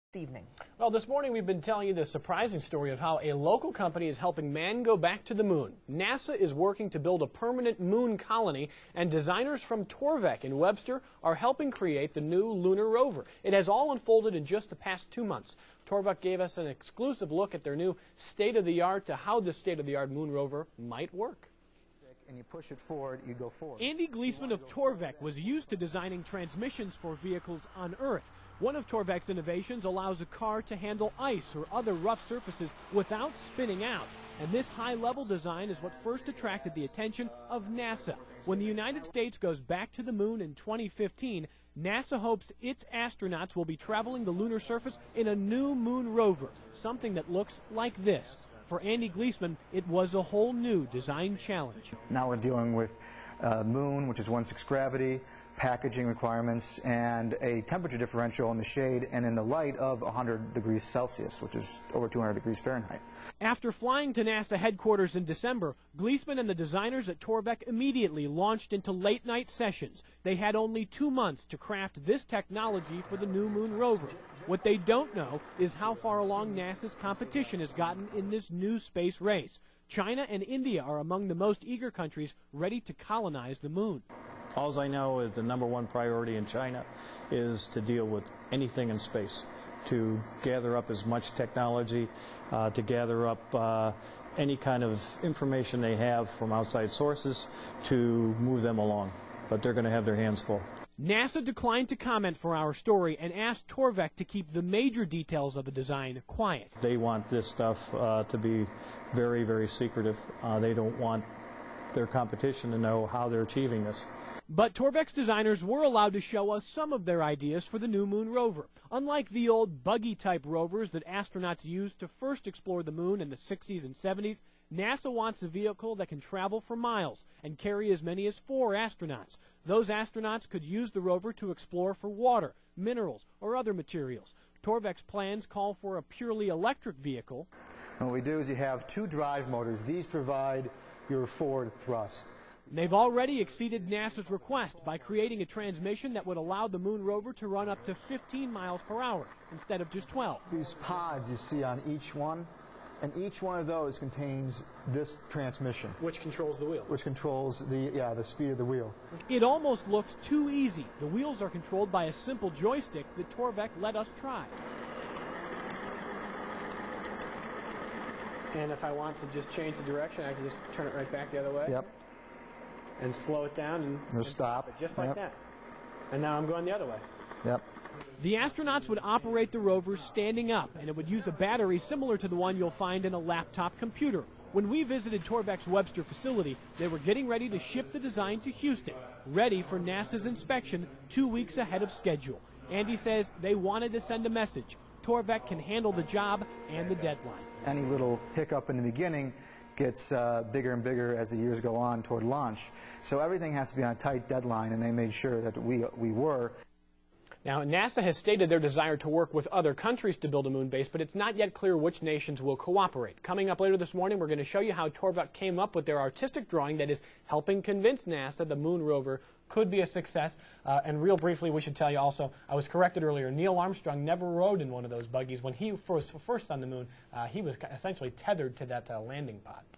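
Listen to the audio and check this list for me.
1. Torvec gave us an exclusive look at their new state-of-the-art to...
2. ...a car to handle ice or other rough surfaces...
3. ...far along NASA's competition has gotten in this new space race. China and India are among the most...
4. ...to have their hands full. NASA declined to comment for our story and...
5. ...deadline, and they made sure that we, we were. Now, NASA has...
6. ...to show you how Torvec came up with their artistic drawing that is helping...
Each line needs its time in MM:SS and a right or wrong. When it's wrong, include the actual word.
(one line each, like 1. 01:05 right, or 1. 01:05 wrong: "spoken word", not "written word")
1. 00:15 right
2. 00:30 right
3. 01:15 right
4. 01:39 right
5. 03:24 right
6. 03:34 right.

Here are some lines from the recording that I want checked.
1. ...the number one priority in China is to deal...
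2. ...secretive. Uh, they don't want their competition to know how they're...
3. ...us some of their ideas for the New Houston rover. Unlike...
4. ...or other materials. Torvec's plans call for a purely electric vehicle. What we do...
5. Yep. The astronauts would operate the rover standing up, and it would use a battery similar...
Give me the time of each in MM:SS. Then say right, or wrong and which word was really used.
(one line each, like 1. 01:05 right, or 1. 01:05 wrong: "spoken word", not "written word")
1. 01:25 right
2. 01:49 right
3. 01:56 wrong: "Moon", not "Houston"
4. 02:13 right
5. 02:57 right.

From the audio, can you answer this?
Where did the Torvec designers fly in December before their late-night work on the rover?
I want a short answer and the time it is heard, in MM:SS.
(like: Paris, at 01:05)
NASA headquarters, at 01:04.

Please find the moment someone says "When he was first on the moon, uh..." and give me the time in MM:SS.
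03:45.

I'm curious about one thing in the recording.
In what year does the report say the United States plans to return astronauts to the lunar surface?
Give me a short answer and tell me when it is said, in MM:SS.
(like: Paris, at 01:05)
2015, at 00:40.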